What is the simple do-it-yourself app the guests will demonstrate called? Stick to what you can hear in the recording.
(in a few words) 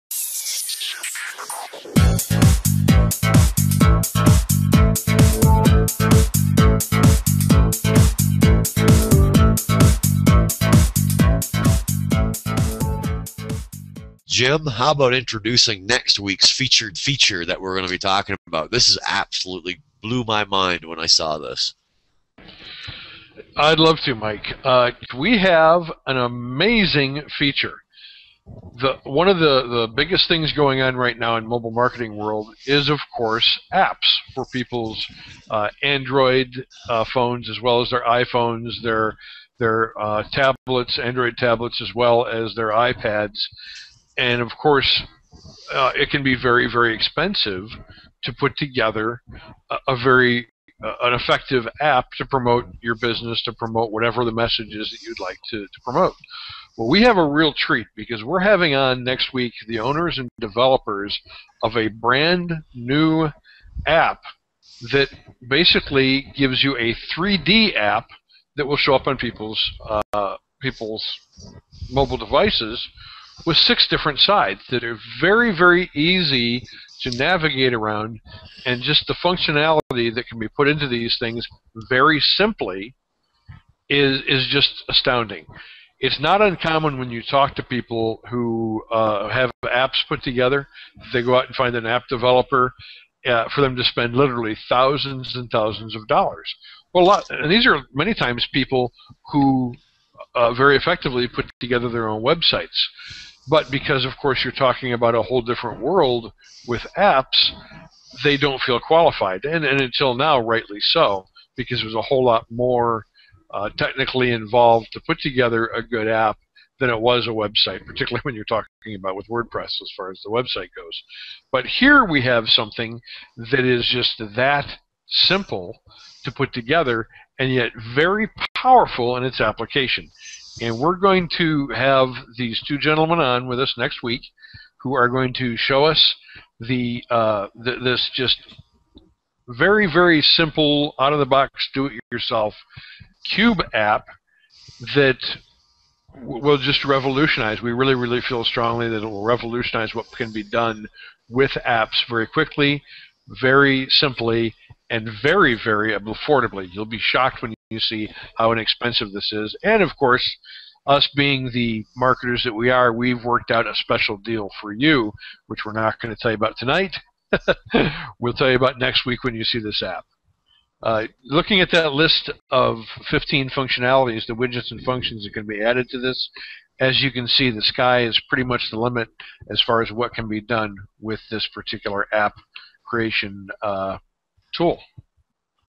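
Cube app.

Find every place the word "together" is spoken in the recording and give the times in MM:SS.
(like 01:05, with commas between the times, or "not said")
00:48, 01:30, 01:41, 01:55, 02:06.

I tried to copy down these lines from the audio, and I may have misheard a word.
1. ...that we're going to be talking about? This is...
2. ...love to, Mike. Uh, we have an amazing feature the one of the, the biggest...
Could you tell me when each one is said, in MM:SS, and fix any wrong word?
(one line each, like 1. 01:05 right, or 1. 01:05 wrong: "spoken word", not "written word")
1. 00:17 right
2. 00:23 right.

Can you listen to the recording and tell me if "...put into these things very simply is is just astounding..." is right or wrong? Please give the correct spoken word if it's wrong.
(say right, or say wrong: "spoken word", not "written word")
right.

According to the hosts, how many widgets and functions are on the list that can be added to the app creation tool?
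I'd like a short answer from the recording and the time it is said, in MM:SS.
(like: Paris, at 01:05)
15, at 02:53.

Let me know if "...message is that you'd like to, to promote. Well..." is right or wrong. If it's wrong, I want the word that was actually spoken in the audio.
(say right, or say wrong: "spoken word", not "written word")
right.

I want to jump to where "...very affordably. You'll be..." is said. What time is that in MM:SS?
02:35.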